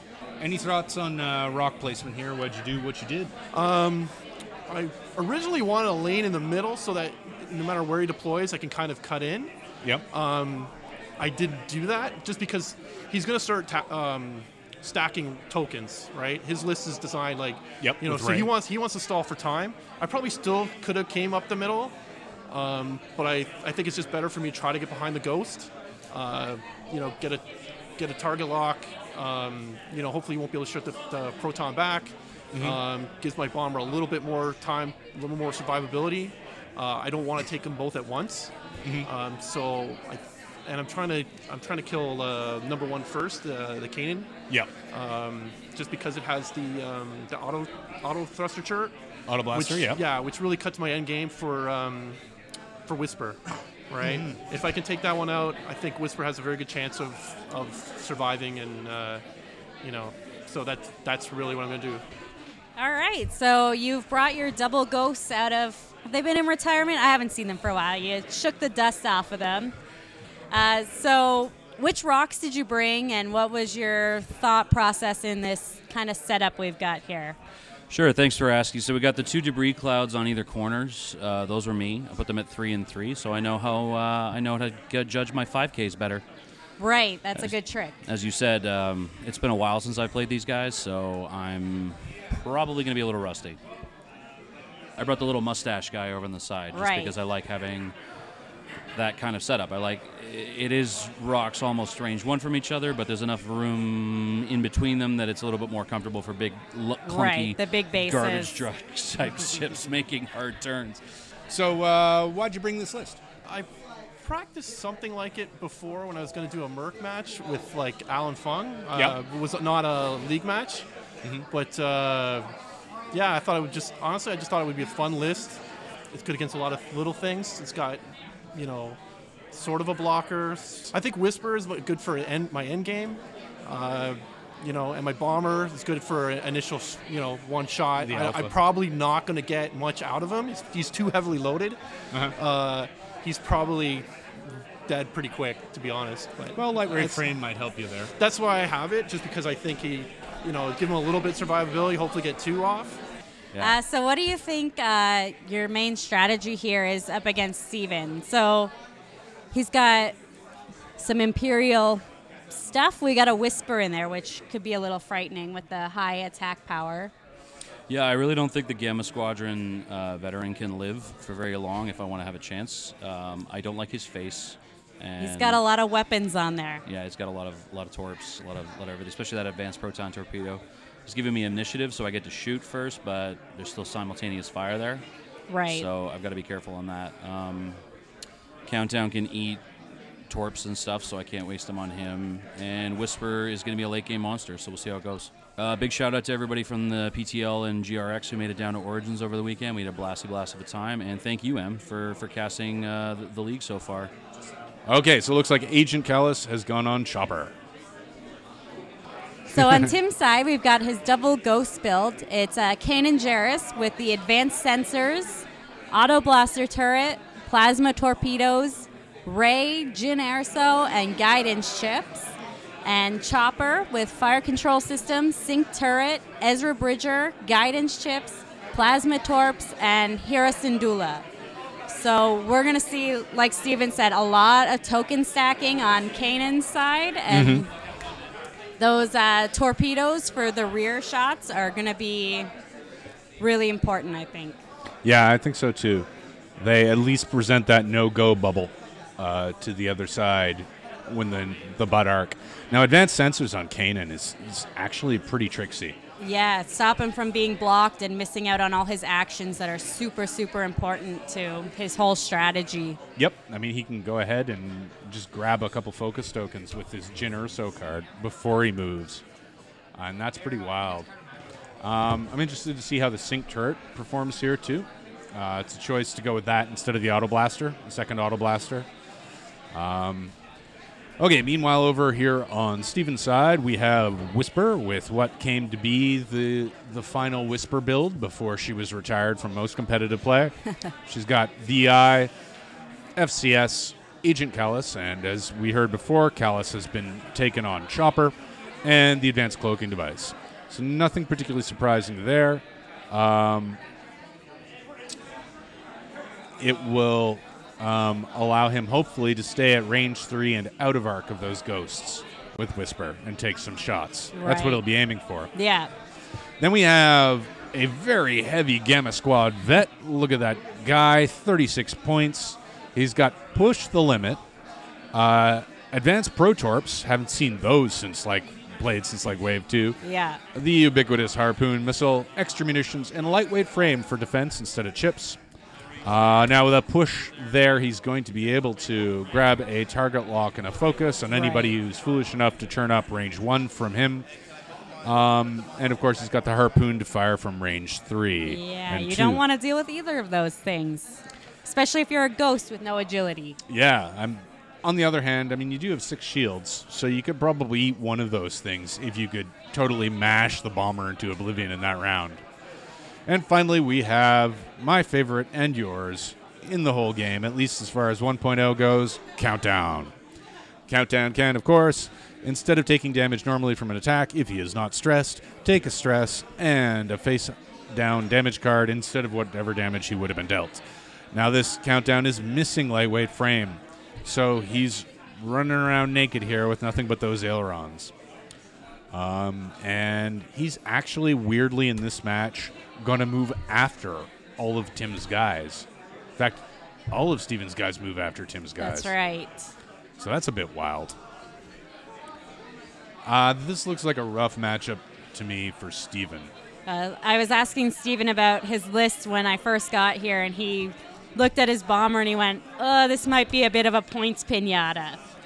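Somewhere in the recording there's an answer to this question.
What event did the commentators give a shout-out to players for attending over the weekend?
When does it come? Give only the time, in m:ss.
3:18.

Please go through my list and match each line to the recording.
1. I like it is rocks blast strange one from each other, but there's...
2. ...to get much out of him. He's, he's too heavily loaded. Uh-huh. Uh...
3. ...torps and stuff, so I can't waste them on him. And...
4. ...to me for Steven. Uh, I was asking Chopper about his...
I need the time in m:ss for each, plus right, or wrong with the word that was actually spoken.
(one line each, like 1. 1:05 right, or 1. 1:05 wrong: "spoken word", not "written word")
1. 1:39 wrong: "almost", not "blast"
2. 2:19 right
3. 3:10 right
4. 6:45 wrong: "Steven", not "Chopper".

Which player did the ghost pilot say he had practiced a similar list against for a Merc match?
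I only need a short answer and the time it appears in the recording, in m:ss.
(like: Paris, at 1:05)
Alan Fung, at 1:58.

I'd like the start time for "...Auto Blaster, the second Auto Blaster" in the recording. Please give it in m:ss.
4:37.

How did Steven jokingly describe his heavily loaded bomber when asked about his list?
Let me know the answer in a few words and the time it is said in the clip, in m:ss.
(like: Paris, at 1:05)
a points pinata, at 6:54.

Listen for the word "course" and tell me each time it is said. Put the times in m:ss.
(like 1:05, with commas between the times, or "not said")
5:46, 6:11.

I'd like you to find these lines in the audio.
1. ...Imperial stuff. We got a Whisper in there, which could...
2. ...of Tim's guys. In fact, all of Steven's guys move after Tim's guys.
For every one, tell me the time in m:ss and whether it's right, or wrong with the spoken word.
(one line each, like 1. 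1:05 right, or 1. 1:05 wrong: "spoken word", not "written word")
1. 2:41 right
2. 6:34 right.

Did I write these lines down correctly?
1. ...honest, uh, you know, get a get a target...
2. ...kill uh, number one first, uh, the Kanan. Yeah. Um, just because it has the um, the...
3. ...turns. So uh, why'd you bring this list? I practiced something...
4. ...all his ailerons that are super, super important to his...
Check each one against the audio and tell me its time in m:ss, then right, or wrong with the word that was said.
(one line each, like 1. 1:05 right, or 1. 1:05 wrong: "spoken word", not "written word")
1. 0:25 wrong: "ghost", not "honest"
2. 0:41 right
3. 1:50 right
4. 4:18 wrong: "actions", not "ailerons".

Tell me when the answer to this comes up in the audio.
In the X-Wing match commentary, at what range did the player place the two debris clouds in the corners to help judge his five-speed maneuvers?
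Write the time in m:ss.
1:22.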